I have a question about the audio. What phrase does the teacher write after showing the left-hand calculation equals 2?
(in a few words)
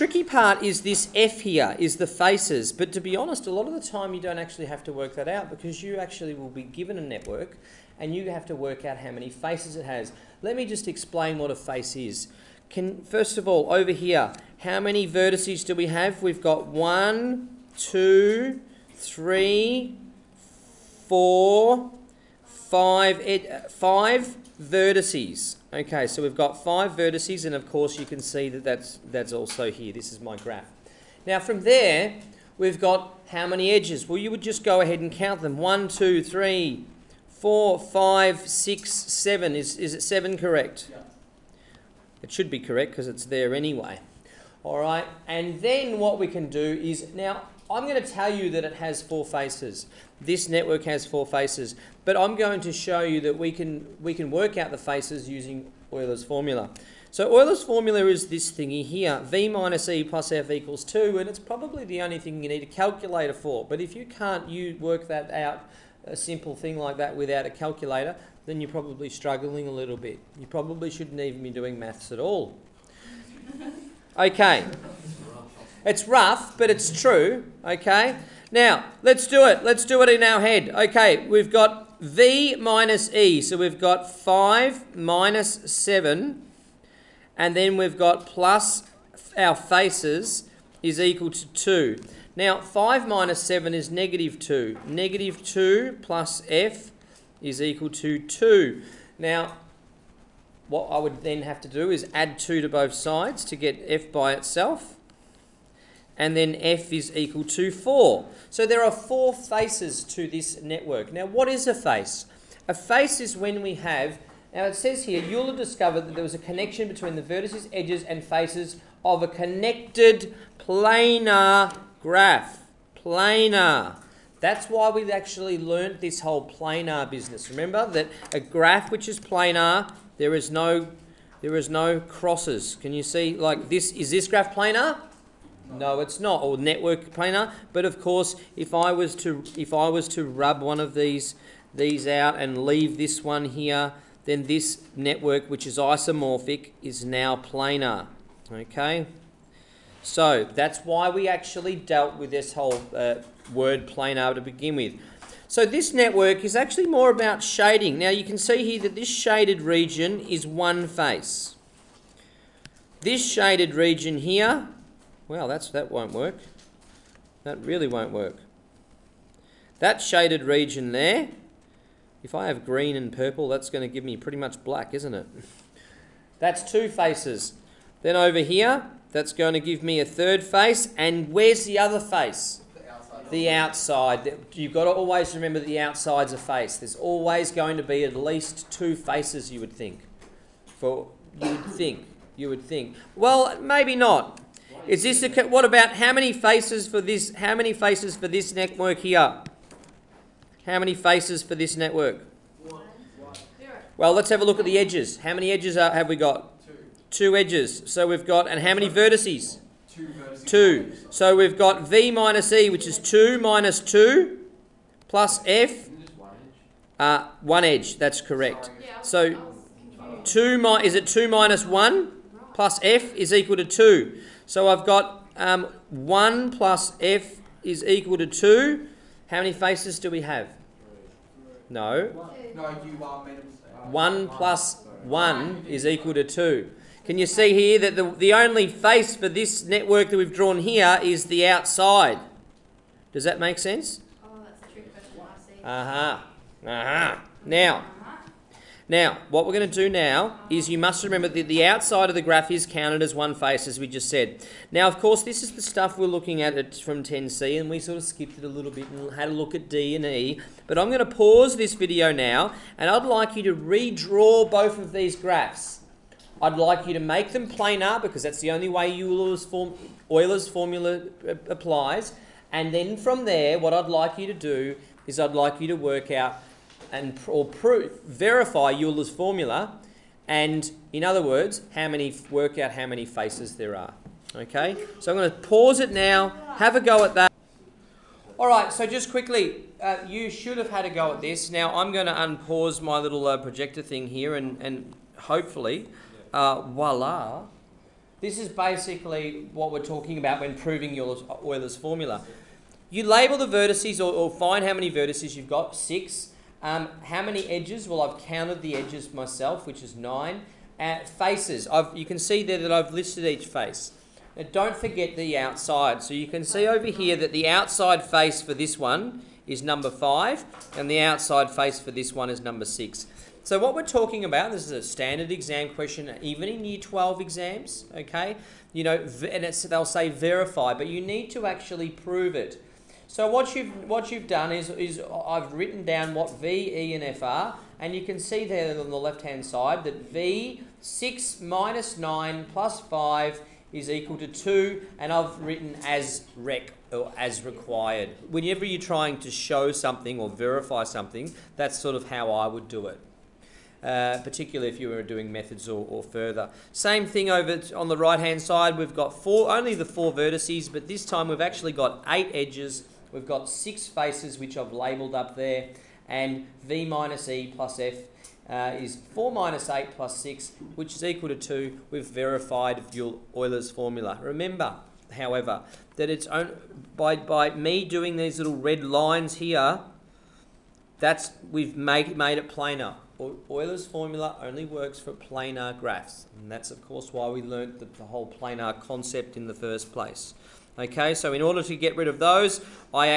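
As required.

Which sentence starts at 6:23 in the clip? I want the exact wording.
Euler's formula only works for planar graphs.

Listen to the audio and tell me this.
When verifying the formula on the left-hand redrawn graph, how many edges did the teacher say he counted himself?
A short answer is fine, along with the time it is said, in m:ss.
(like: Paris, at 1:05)
9, at 5:09.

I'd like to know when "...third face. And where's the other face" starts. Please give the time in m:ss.
3:00.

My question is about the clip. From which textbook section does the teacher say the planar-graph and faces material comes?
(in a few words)
10C.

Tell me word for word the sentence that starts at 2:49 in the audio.
That shaded region there, if I have green and purple, that's going to give me pretty much black, isn't it?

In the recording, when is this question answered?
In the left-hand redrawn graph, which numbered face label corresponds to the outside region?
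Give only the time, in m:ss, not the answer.
5:19.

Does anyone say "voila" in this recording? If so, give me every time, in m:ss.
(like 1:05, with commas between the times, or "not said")
4:56.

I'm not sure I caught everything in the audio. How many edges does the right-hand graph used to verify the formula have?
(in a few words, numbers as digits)
8.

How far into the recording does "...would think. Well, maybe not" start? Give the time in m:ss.
3:12.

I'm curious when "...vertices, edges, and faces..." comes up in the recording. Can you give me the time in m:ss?
1:57.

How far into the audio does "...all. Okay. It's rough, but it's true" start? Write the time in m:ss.
1:12.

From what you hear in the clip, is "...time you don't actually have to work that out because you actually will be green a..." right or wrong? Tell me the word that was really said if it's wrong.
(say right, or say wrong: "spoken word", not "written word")
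wrong: "given", not "green".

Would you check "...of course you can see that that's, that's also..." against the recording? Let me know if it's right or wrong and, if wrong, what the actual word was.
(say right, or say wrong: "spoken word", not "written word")
right.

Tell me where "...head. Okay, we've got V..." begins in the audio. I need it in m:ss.
1:20.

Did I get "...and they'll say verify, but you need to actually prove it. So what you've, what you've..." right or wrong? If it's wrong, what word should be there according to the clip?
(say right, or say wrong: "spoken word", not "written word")
right.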